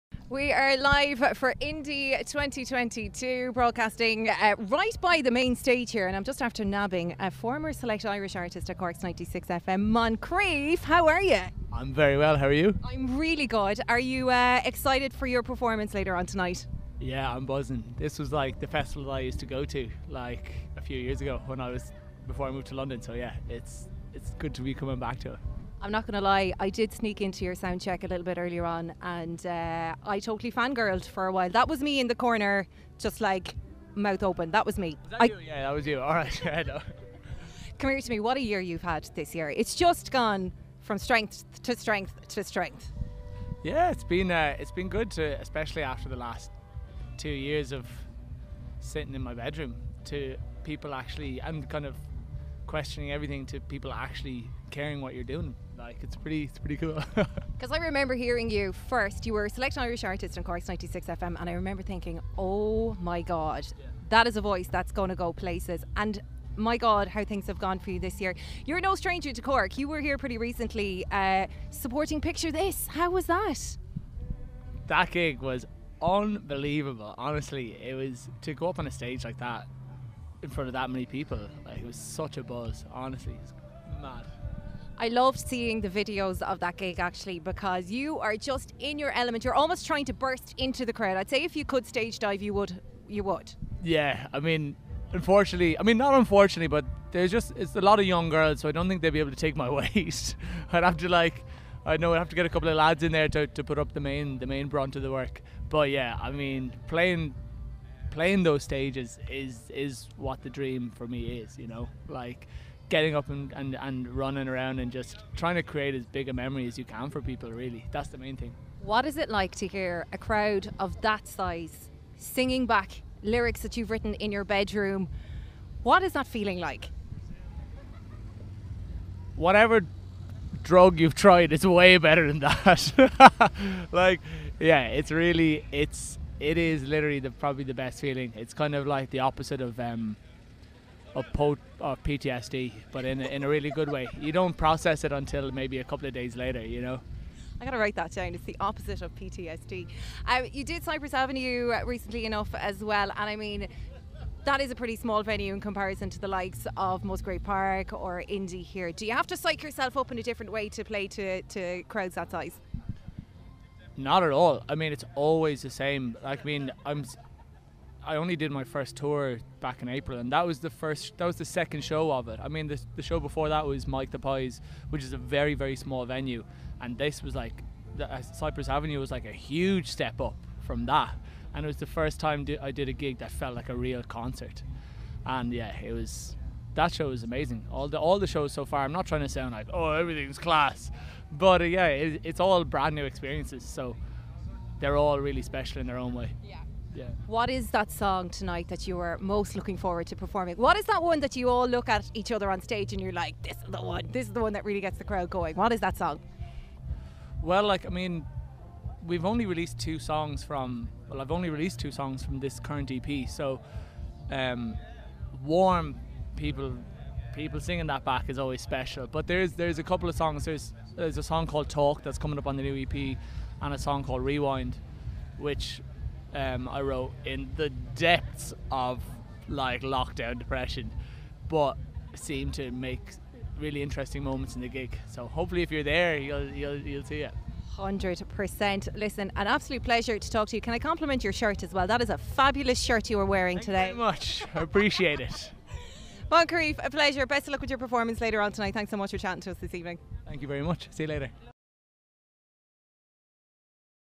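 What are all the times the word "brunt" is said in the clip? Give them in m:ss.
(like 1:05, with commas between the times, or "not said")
1:44.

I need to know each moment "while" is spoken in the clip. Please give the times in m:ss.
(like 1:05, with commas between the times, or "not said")
0:31.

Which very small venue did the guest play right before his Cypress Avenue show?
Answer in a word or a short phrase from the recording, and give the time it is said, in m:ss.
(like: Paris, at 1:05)
Mike the Pies, at 2:53.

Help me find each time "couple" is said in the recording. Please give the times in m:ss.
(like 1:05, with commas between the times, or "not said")
1:42, 2:25, 3:39.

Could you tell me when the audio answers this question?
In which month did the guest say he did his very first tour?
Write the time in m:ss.
2:49.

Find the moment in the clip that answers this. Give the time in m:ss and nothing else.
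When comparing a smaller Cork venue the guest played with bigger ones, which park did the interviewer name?
2:37.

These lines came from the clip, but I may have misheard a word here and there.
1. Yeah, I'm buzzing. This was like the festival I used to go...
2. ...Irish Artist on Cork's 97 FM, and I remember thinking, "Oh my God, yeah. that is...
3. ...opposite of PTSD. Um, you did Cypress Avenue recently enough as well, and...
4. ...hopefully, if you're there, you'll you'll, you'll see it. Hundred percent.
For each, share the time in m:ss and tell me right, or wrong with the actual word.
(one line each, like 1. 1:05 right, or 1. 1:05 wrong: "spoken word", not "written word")
1. 0:17 right
2. 0:59 wrong: "96", not "97"
3. 2:28 right
4. 3:55 right.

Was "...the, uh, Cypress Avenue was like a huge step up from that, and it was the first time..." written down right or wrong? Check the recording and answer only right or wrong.
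right.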